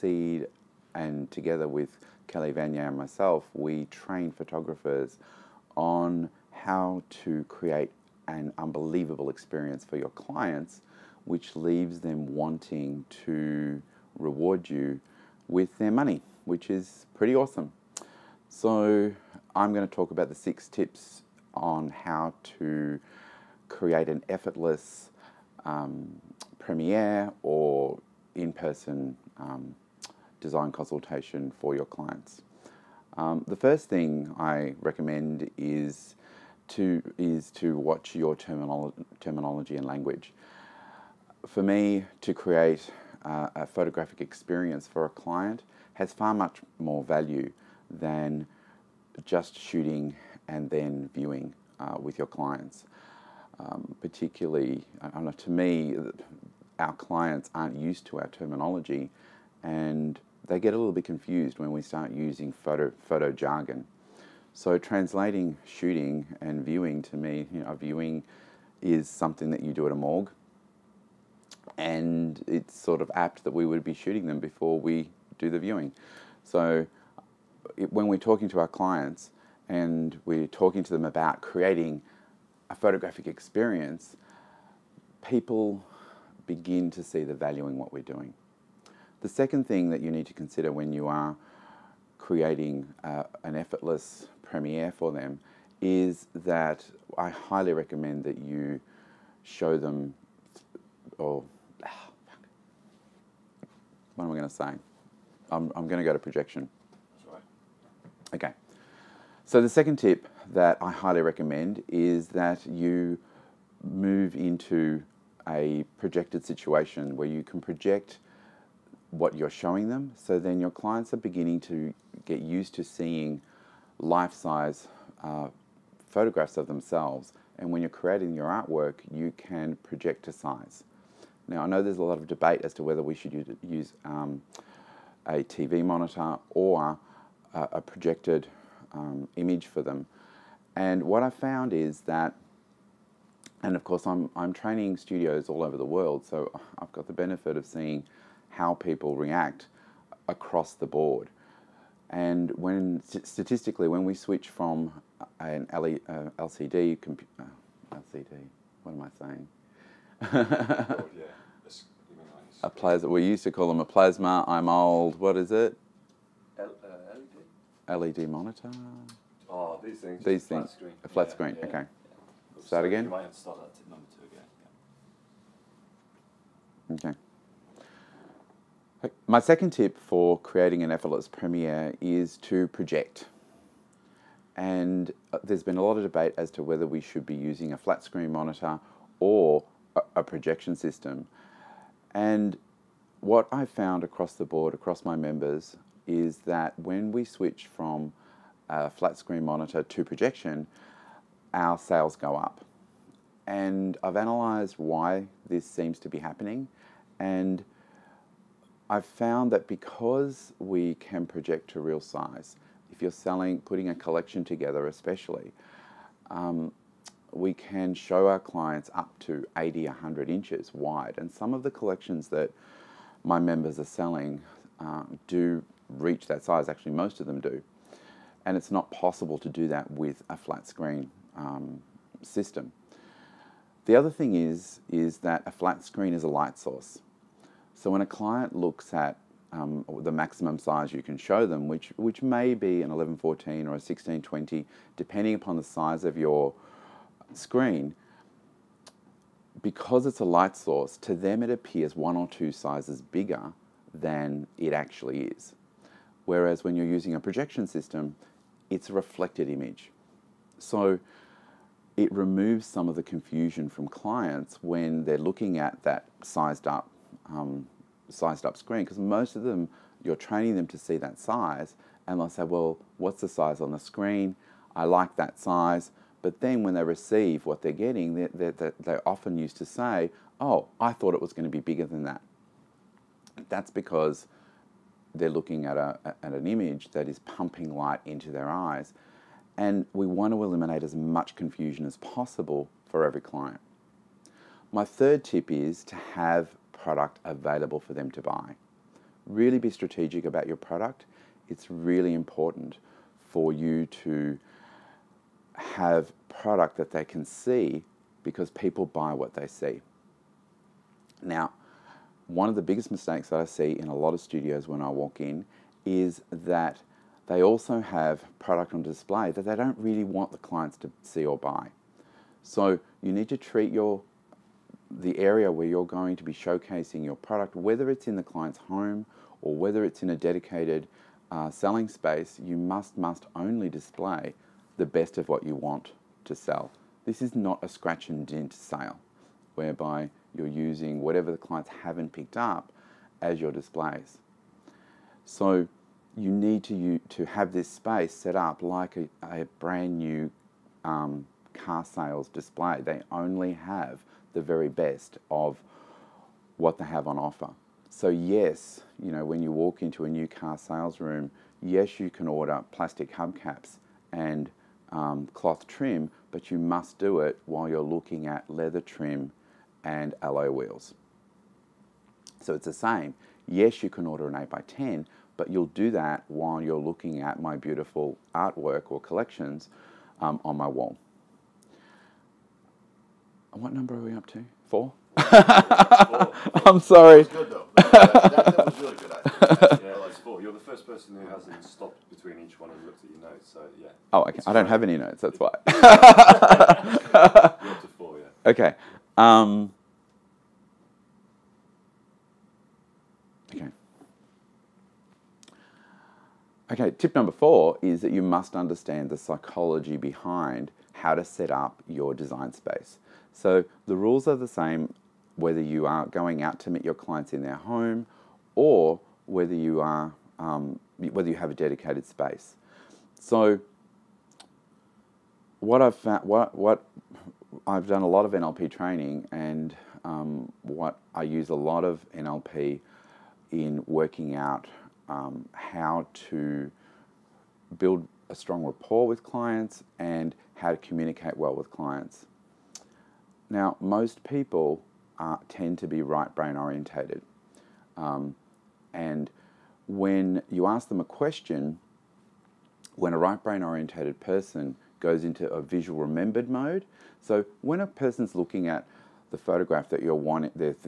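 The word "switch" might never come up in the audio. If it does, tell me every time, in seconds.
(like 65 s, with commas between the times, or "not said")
154 s, 197 s.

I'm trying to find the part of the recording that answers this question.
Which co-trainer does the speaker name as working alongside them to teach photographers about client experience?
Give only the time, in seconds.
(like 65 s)
2 s.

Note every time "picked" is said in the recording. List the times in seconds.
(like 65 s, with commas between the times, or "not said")
342 s.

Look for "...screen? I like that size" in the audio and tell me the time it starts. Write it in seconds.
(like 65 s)
273 s.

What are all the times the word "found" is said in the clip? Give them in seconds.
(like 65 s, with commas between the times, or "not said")
141 s, 193 s, 209 s, 425 s.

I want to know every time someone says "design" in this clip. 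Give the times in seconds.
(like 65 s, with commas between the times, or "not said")
30 s, 412 s.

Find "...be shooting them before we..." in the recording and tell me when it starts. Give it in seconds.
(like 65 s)
73 s.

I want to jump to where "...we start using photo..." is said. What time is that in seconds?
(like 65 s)
61 s.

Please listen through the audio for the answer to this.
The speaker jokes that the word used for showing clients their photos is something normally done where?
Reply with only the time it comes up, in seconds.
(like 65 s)
69 s.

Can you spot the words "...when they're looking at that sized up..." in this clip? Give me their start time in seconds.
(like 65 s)
264 s.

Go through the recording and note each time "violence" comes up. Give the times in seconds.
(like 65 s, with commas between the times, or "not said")
not said.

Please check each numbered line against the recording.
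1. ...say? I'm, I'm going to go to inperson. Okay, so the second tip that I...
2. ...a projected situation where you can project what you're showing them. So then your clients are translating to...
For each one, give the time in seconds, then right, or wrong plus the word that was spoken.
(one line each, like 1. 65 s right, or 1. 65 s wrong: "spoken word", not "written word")
1. 104 s wrong: "projection", not "inperson"
2. 115 s wrong: "beginning", not "translating".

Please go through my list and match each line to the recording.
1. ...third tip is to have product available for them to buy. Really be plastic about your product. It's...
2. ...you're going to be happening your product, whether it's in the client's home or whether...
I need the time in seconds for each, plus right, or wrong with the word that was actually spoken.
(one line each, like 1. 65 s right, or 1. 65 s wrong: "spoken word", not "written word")
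1. 294 s wrong: "strategic", not "plastic"
2. 325 s wrong: "showcasing", not "happening".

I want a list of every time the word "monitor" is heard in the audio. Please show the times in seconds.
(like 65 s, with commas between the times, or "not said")
135 s, 168 s, 188 s, 199 s.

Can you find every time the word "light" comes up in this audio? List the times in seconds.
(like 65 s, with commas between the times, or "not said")
236 s, 250 s, 287 s.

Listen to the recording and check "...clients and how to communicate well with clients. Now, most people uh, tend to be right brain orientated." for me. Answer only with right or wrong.
right.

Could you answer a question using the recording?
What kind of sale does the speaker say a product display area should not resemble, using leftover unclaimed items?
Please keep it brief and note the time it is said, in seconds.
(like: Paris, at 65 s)
Scratch and dent sale, at 337 s.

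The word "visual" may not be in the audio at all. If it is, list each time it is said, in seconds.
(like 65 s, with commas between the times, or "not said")
455 s.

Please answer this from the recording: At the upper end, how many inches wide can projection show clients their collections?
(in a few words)
100 inches.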